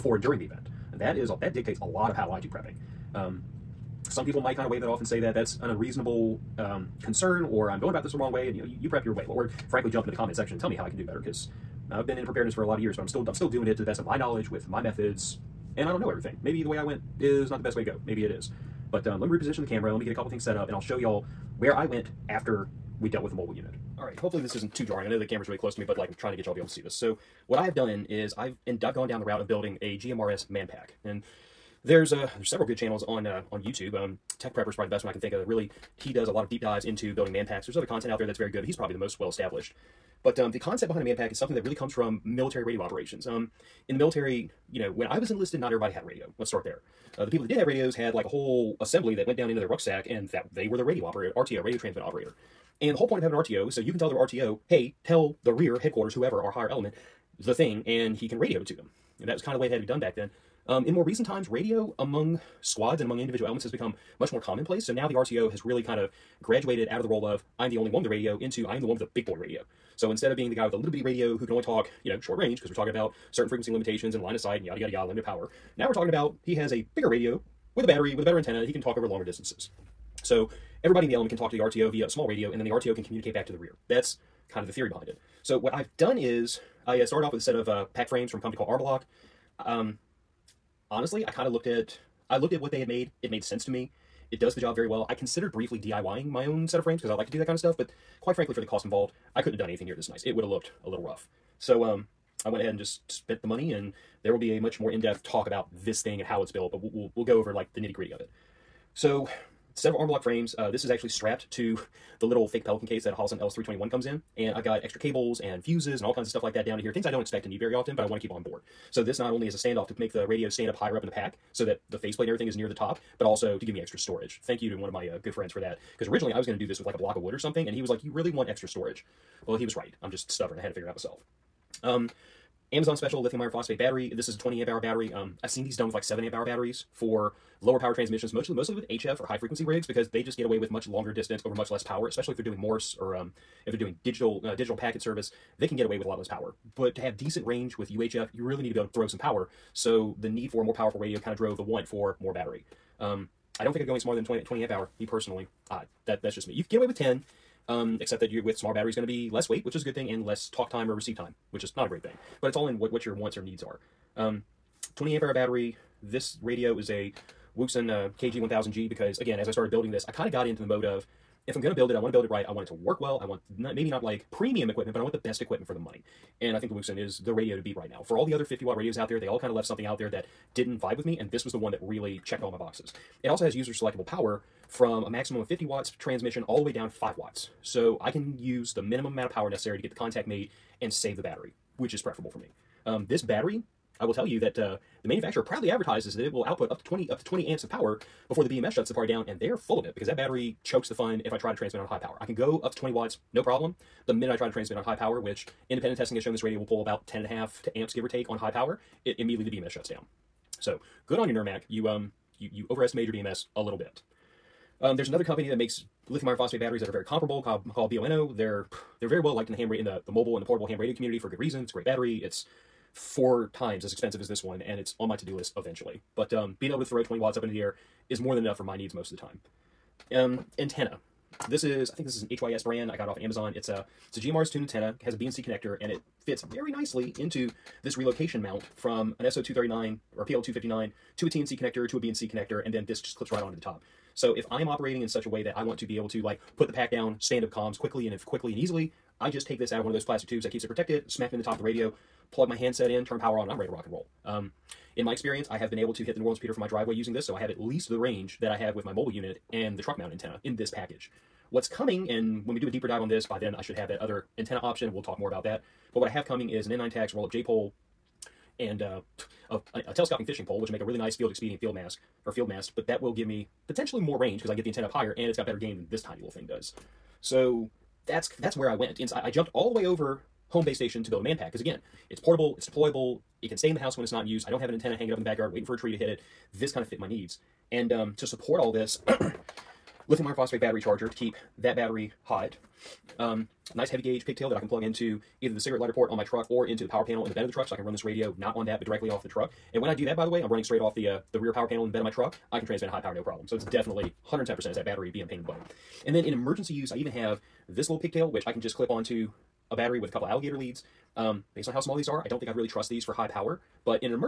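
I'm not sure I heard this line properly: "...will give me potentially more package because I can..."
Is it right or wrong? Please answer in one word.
wrong.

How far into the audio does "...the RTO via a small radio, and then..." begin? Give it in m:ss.
1:21.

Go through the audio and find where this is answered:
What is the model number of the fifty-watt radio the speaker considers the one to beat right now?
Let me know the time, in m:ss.
2:48.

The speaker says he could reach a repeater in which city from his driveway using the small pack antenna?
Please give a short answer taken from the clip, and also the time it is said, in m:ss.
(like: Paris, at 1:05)
New Orleans, at 4:16.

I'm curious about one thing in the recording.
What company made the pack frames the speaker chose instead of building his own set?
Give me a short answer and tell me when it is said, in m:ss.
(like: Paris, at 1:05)
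Arbalock, at 1:28.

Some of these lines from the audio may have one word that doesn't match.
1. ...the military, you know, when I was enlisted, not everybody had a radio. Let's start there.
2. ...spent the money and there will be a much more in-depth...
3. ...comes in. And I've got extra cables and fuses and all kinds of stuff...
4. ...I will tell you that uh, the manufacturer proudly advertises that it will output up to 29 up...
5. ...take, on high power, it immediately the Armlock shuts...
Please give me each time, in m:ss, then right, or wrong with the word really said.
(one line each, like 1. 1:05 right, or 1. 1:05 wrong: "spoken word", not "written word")
1. 0:43 right
2. 1:43 right
3. 1:53 right
4. 3:13 wrong: "20", not "29"
5. 3:28 wrong: "BMS", not "Armlock".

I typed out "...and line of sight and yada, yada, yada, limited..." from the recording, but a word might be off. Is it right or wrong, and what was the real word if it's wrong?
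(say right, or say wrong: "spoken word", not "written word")
right.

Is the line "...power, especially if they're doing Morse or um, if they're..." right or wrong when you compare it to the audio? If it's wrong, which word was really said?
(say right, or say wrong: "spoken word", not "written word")
right.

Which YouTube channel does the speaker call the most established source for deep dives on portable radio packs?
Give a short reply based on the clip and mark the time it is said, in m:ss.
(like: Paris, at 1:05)
Tech Prepper, at 0:34.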